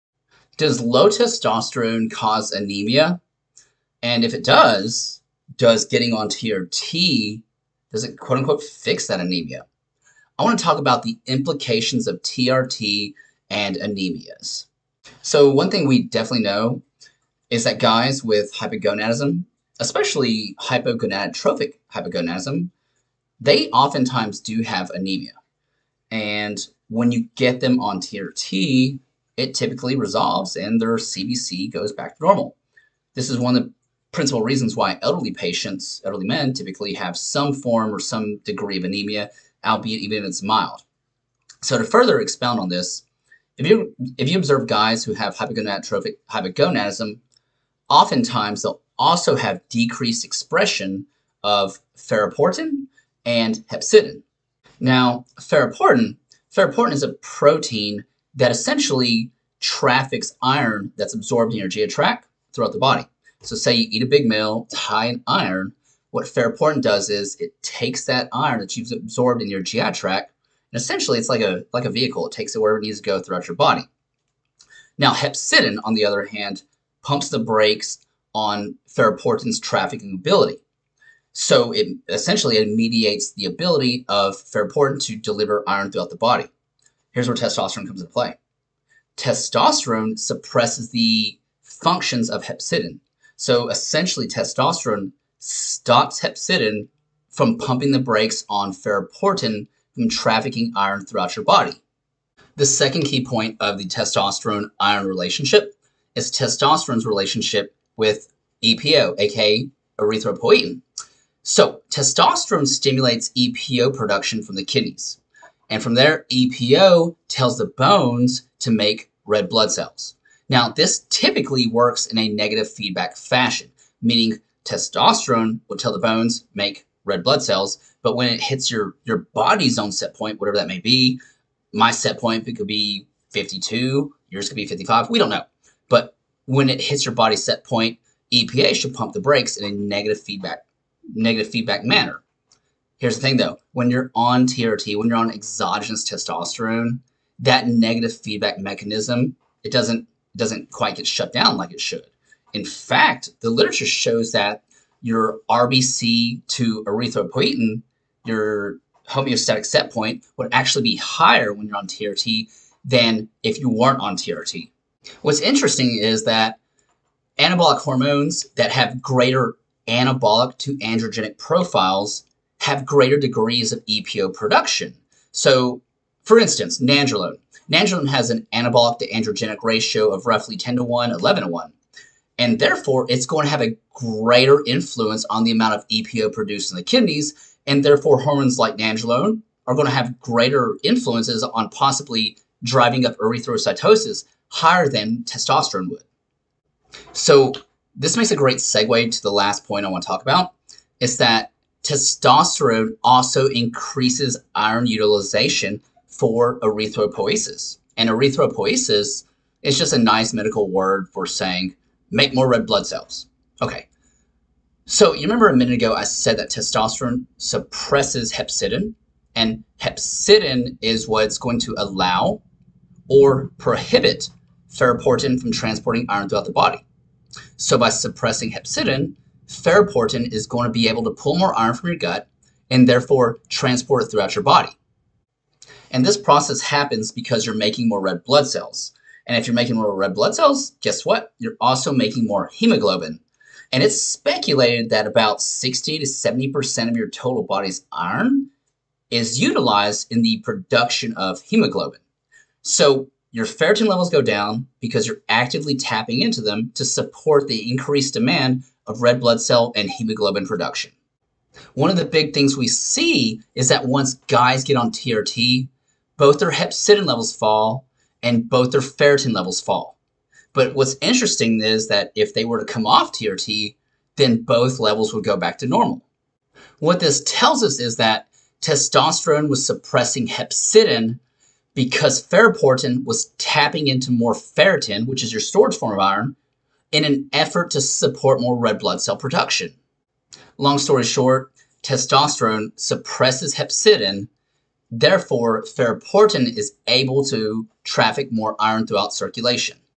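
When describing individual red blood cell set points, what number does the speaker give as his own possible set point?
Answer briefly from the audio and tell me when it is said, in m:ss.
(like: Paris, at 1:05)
52, at 2:13.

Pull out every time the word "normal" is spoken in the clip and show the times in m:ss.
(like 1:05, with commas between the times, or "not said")
0:32, 4:35.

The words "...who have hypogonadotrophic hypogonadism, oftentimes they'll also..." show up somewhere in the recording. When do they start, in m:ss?
0:45.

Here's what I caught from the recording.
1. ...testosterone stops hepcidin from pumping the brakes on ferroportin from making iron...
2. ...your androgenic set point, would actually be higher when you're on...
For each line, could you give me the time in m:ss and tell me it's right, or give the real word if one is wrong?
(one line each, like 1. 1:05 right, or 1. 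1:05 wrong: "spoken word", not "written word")
1. 1:34 wrong: "trafficking", not "making"
2. 2:38 wrong: "homeostatic", not "androgenic".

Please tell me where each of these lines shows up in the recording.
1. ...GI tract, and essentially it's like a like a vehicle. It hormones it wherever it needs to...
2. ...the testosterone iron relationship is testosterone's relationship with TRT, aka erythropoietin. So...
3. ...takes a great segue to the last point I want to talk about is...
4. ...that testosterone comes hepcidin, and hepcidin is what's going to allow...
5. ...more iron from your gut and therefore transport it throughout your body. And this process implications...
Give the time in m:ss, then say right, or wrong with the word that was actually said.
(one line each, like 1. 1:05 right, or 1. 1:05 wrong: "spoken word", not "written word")
1. 1:09 wrong: "takes", not "hormones"
2. 1:43 wrong: "EPO", not "TRT"
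3. 3:18 wrong: "makes", not "takes"
4. 3:36 wrong: "suppresses", not "comes"
5. 3:51 wrong: "happens", not "implications".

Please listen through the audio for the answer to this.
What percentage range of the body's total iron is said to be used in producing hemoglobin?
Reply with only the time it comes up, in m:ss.
4:05.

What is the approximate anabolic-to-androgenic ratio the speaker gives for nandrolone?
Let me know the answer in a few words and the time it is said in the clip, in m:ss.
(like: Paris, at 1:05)
10 to 1, at 3:00.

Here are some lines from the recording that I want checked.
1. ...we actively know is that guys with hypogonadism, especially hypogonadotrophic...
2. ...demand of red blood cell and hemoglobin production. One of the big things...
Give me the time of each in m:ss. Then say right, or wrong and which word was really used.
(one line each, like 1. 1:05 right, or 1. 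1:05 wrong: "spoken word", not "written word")
1. 0:15 wrong: "definitely", not "actively"
2. 4:18 right.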